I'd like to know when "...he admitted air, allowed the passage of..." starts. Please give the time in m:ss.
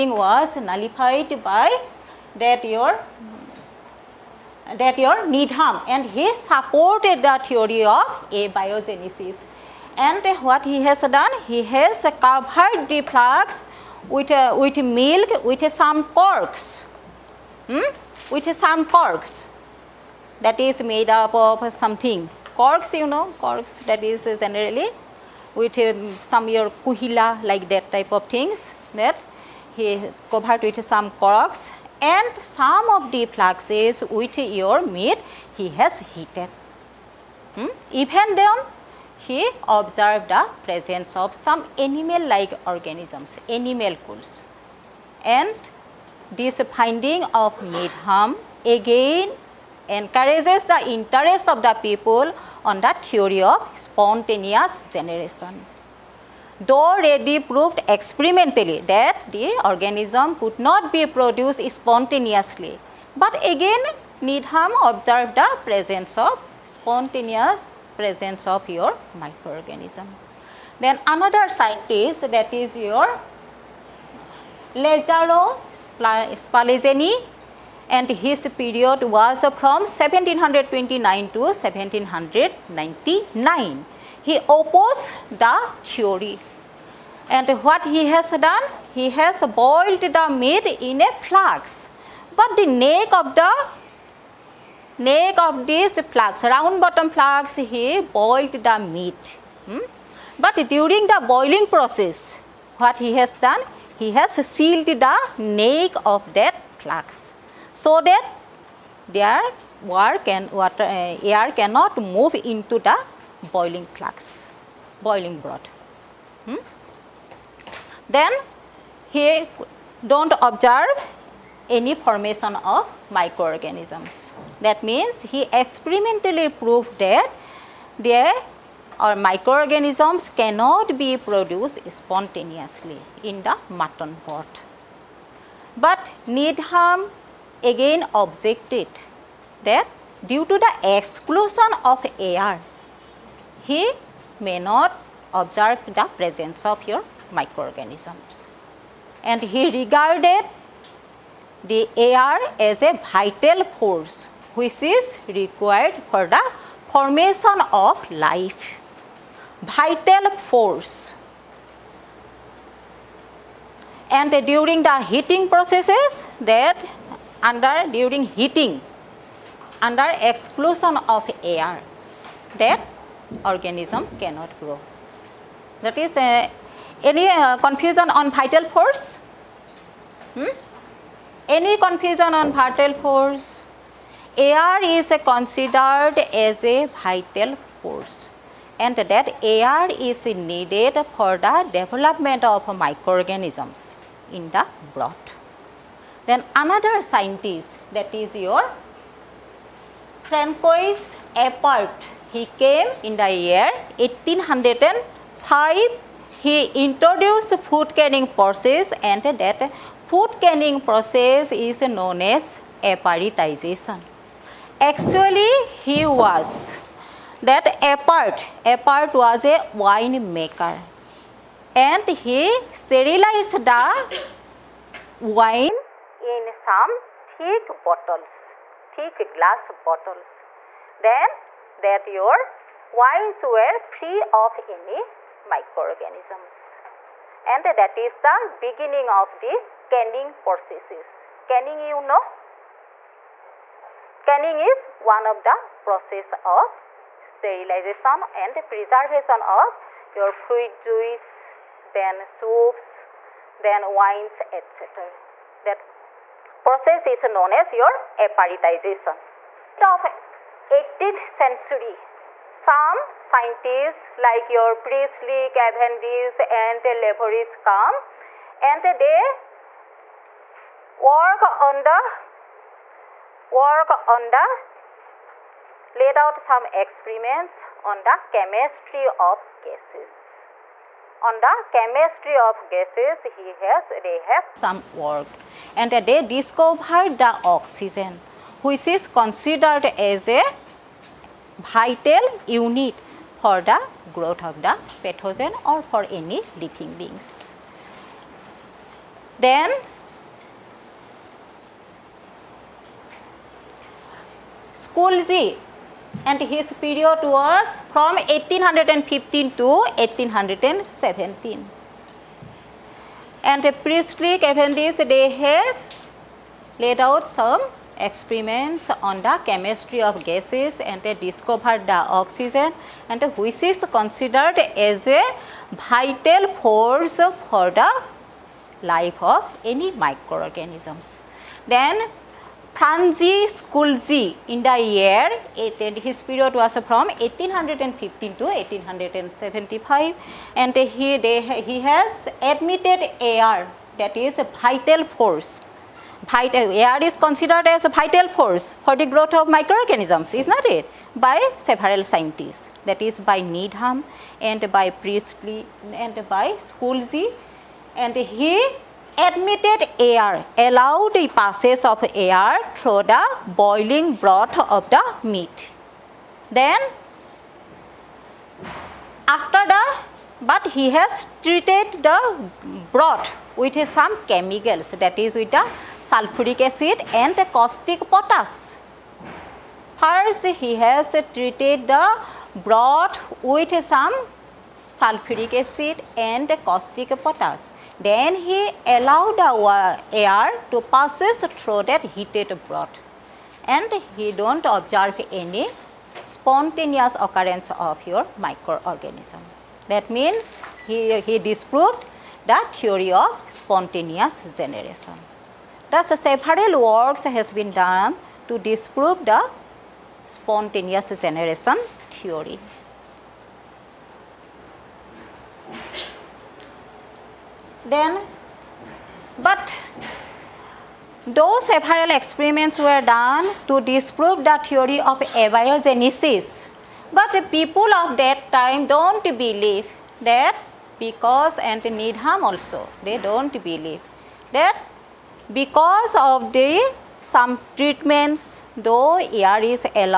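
5:58.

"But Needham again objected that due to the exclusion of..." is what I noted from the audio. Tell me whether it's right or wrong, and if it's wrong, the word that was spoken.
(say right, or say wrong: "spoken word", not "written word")
right.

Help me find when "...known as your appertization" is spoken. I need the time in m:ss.
4:17.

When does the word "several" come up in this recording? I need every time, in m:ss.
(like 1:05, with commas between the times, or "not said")
5:51, 6:46, 7:01.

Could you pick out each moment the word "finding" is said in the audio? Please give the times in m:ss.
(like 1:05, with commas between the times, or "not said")
0:46.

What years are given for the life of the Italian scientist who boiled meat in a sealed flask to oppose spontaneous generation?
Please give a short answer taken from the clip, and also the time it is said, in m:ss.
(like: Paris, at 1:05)
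1729 to 1799, at 1:19.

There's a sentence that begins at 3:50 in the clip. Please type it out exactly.
Then that your wines were free of any microorganisms.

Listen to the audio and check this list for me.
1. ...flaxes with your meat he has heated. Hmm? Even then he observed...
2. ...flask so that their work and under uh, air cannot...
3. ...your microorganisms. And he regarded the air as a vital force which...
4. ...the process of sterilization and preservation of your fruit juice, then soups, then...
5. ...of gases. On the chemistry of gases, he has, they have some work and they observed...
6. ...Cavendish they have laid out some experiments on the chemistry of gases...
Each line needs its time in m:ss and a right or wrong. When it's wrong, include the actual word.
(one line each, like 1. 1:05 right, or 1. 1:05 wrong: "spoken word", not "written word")
1. 0:33 right
2. 1:46 wrong: "water", not "under"
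3. 2:26 right
4. 4:05 right
5. 4:39 wrong: "discovered", not "observed"
6. 5:14 right.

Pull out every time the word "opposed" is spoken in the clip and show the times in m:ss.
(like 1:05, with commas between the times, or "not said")
1:24.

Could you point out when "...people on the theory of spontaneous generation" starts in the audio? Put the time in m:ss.
0:51.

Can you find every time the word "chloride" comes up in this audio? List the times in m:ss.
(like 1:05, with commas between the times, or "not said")
not said.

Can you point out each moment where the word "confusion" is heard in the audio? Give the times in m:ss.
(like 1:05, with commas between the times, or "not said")
2:57, 3:01.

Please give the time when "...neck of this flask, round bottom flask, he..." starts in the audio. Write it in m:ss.
1:34.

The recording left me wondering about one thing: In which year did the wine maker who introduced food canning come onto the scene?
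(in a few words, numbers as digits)
1805.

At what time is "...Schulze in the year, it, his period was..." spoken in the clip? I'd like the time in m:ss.
5:33.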